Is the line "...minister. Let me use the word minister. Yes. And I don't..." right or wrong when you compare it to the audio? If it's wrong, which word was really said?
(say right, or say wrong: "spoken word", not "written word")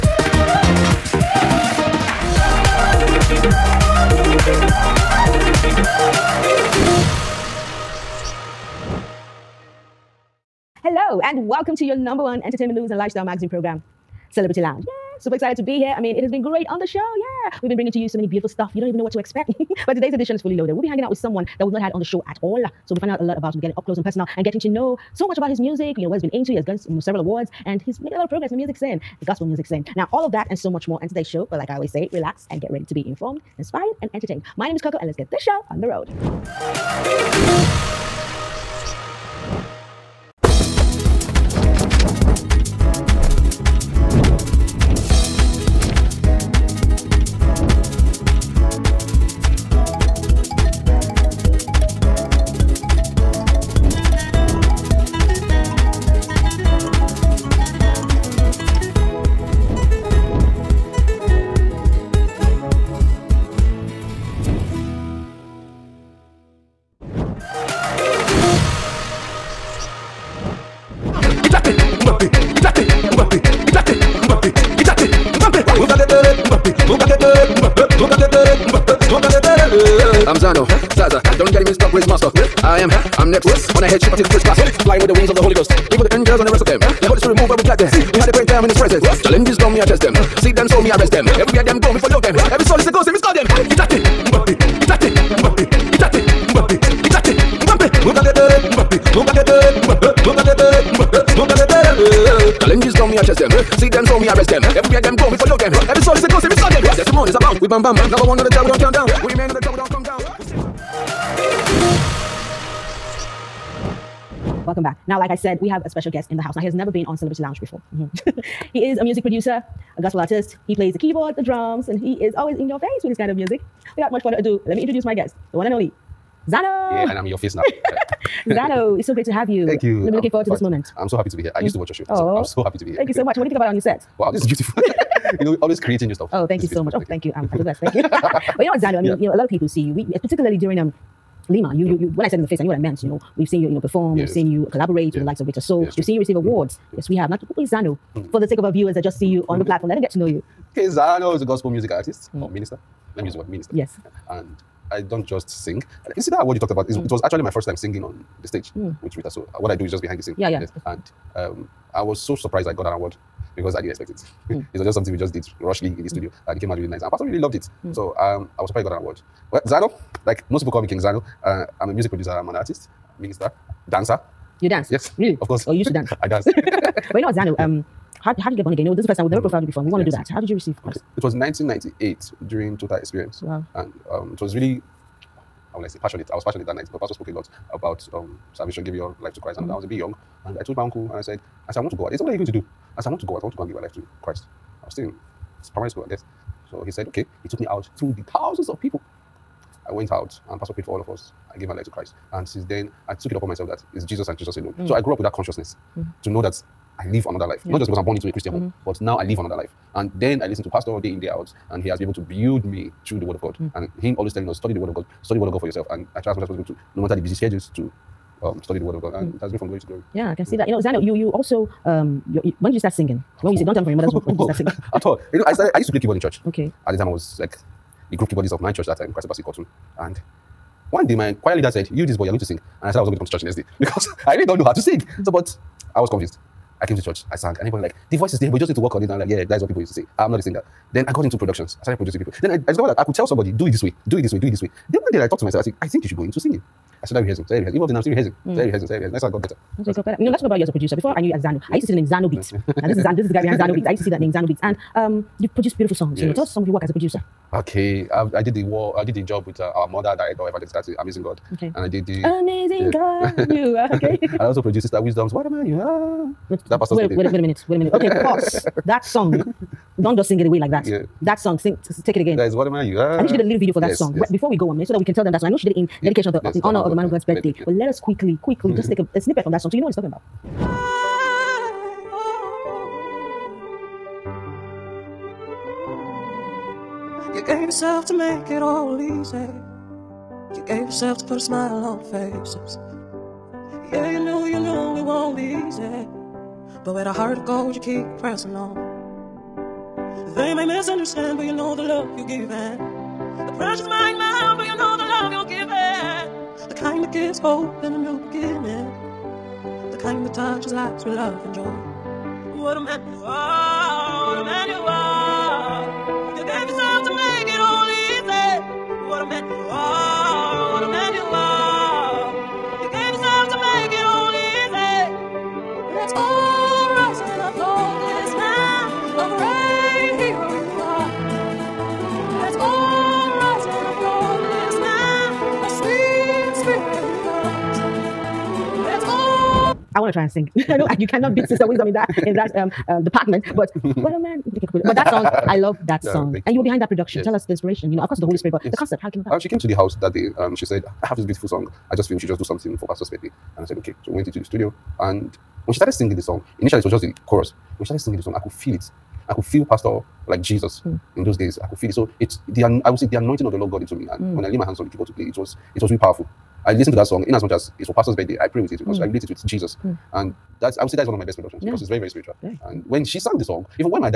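right.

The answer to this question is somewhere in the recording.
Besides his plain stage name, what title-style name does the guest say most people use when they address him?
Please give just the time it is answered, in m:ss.
2:50.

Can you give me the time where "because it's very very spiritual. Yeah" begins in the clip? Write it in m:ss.
6:11.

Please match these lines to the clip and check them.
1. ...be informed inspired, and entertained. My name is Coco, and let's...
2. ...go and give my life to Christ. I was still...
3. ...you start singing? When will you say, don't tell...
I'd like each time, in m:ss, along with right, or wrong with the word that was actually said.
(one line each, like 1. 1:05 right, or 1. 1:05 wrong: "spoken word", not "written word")
1. 0:32 right
2. 3:13 right
3. 3:42 right.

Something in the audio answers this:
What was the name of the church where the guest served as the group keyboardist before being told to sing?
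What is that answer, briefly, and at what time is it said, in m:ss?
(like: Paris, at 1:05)
Christ Basket Cotton, at 3:49.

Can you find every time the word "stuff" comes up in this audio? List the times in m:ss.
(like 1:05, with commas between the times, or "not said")
0:18, 2:16.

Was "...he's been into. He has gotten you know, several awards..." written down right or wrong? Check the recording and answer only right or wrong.
right.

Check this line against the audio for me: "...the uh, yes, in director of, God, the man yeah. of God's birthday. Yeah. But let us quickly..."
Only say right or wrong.
wrong.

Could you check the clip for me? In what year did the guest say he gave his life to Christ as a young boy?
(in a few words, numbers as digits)
1998.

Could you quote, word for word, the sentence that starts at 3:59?
And I'm like, yeah, that is what people used to say.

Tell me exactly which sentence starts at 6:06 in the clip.
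I listened to that song in as much as it's for pastor's birthday.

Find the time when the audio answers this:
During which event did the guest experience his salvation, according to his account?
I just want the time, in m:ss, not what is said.
3:02.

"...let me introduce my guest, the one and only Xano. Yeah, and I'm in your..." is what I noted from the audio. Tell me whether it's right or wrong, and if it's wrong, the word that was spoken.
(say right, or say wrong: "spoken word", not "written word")
right.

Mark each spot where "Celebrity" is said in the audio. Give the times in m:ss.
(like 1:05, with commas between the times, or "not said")
0:14, 1:57.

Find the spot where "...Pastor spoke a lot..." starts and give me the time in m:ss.
3:07.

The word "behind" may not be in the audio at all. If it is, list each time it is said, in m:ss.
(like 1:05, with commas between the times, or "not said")
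2:40, 4:13, 5:46.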